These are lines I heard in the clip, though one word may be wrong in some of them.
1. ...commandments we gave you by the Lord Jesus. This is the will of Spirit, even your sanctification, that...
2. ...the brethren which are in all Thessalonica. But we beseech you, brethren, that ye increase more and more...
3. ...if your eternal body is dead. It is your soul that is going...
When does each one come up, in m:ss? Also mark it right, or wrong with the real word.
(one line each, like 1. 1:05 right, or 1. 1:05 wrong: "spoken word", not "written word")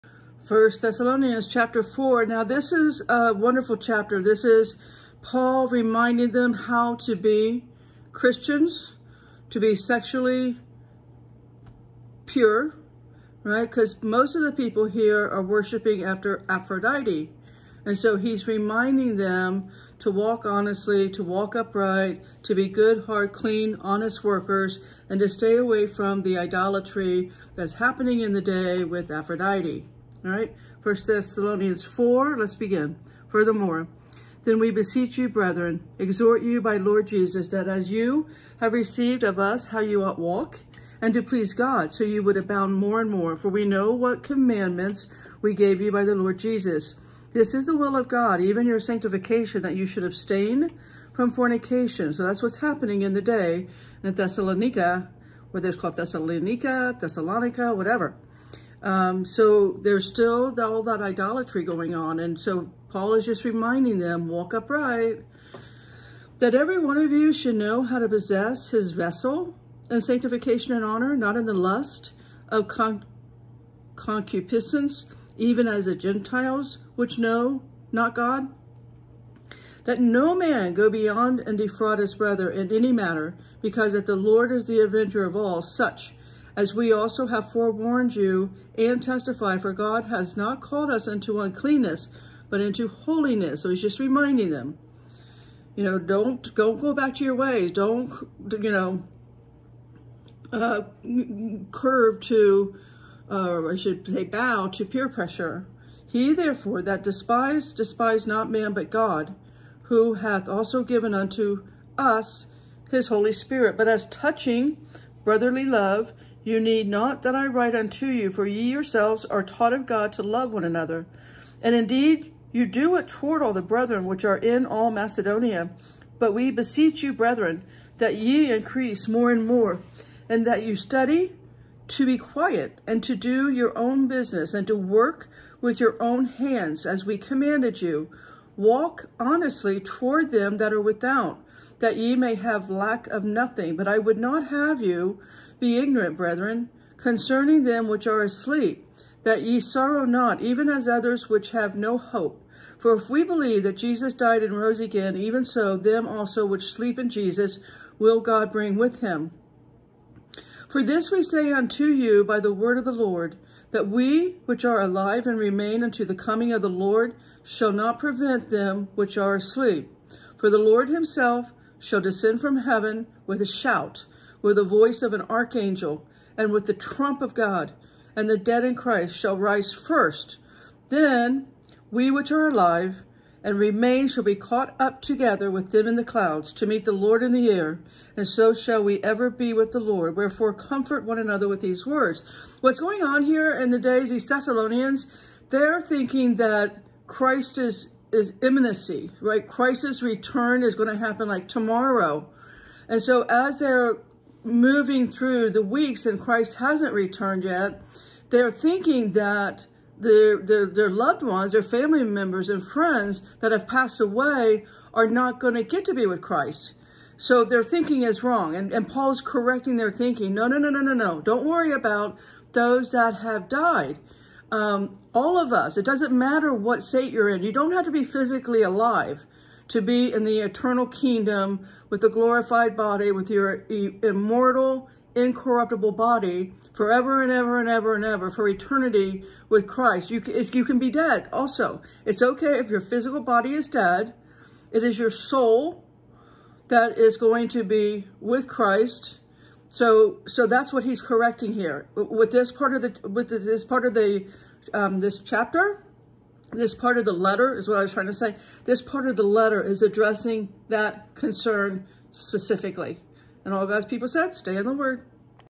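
1. 0:44 wrong: "God", not "Spirit"
2. 2:03 wrong: "Macedonia", not "Thessalonica"
3. 4:02 wrong: "physical", not "eternal".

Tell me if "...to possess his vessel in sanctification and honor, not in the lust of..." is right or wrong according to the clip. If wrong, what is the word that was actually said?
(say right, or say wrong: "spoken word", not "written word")
right.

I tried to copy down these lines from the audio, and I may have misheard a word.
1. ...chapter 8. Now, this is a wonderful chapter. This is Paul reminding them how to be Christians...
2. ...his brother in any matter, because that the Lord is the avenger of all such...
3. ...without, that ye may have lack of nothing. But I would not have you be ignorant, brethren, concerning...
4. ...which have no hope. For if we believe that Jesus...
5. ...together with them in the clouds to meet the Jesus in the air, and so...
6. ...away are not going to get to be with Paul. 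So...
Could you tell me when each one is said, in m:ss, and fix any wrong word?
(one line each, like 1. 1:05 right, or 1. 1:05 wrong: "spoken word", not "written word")
1. 0:01 wrong: "4", not "8"
2. 1:21 right
3. 2:20 right
4. 2:31 right
5. 3:05 wrong: "Lord", not "Jesus"
6. 3:34 wrong: "Christ", not "Paul".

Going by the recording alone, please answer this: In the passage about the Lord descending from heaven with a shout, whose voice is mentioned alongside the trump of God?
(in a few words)
an archangel.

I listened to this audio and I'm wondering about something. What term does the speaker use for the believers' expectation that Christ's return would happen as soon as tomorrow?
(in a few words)
imminency.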